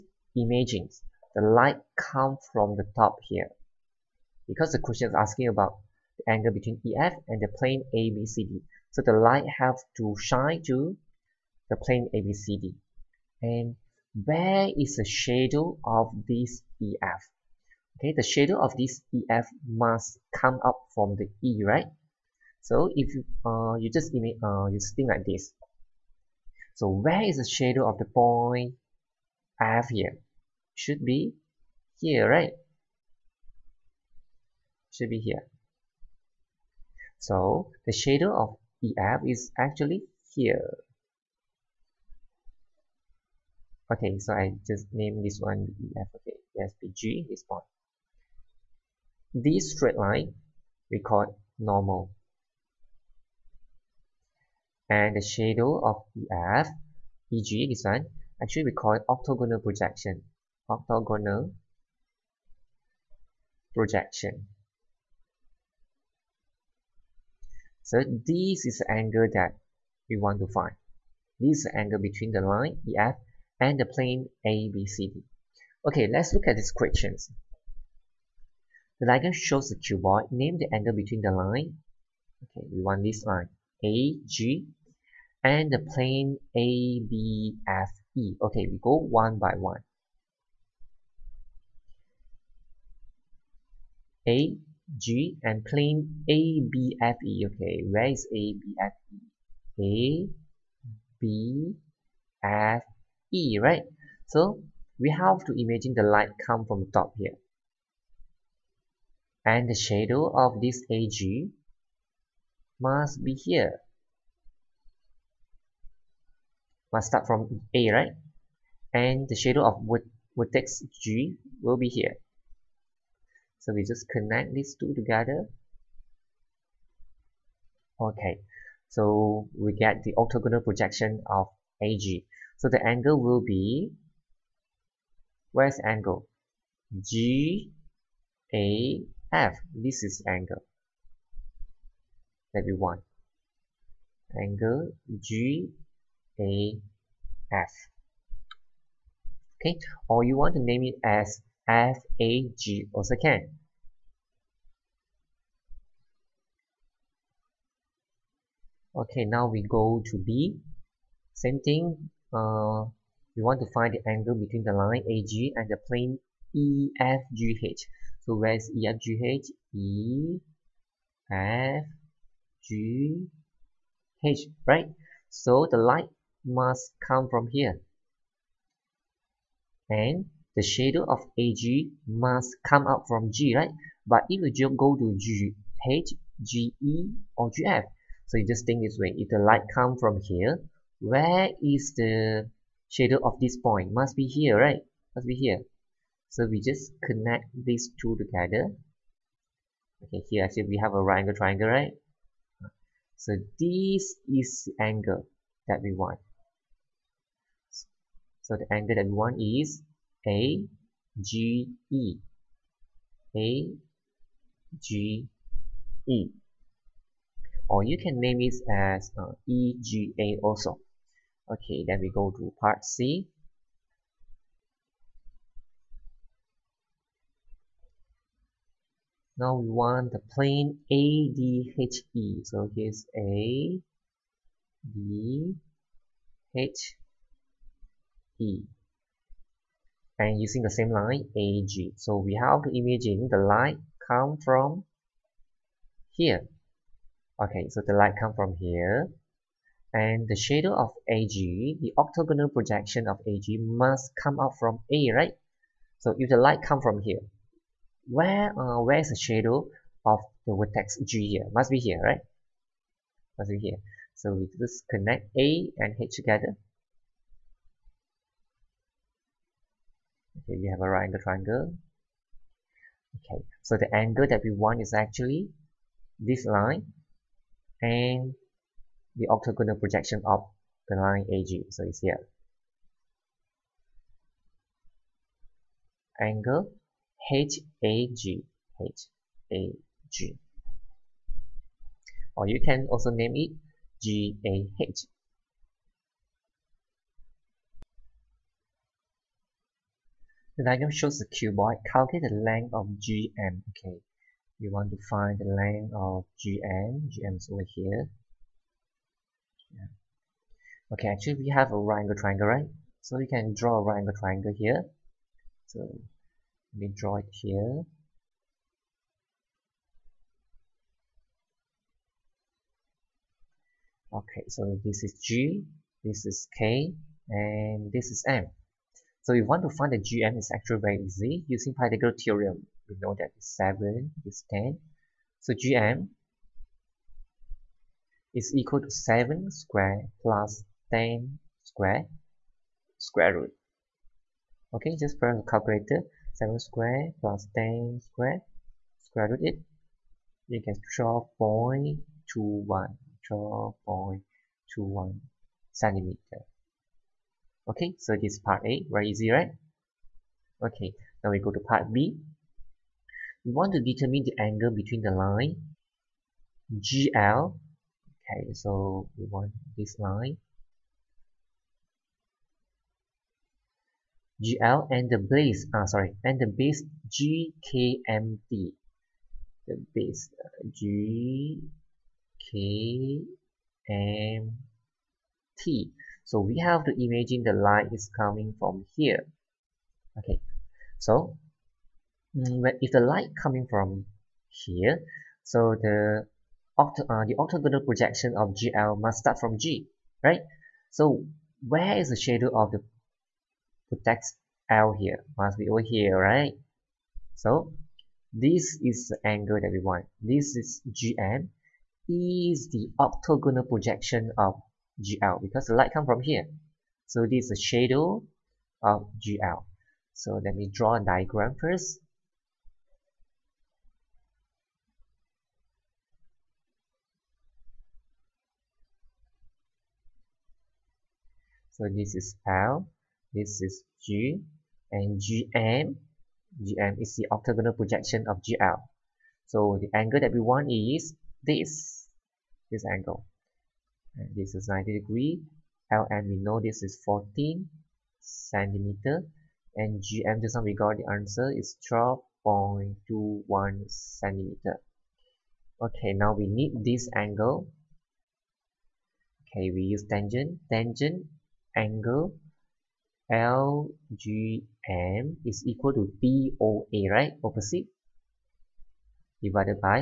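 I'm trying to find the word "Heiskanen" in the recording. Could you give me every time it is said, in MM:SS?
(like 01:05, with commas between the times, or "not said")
not said.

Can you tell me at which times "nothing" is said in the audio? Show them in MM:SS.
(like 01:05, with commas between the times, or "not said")
not said.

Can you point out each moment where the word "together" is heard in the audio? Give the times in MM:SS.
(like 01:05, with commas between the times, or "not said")
02:04, 03:18, 04:26.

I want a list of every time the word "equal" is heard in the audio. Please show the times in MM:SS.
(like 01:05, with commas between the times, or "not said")
05:38, 07:45.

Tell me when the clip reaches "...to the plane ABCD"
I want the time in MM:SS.
00:10.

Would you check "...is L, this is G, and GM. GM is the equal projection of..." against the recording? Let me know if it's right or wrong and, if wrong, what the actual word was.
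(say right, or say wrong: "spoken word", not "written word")
wrong: "orthogonal", not "equal".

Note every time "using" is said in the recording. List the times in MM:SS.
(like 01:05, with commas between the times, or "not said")
04:00, 05:31.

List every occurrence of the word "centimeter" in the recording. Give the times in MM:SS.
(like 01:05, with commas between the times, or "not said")
05:55, 07:28, 07:33.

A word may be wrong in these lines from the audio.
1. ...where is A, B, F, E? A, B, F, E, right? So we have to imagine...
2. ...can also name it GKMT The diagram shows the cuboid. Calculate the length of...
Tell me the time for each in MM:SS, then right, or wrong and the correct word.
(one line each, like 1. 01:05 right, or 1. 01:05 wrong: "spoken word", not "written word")
1. 01:37 right
2. 04:52 wrong: "GAH", not "GKMT".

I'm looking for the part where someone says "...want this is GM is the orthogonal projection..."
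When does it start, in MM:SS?
06:49.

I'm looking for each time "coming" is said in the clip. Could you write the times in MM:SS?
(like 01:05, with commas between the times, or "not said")
06:28, 06:33.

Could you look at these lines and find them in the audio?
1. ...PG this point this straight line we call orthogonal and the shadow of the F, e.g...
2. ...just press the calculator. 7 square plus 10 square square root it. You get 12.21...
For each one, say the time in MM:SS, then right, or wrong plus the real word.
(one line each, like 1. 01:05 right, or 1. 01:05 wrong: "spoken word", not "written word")
1. 00:46 wrong: "normal", not "orthogonal"
2. 05:44 right.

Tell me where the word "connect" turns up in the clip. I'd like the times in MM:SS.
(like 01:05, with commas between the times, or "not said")
02:04, 03:17, 04:24.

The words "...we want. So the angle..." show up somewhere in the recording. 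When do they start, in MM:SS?
03:25.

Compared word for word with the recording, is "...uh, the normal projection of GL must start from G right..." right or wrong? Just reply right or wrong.
wrong.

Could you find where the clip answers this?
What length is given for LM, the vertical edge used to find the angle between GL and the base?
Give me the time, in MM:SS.
07:27.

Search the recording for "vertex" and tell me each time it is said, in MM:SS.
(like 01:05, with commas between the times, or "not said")
02:00, 04:20.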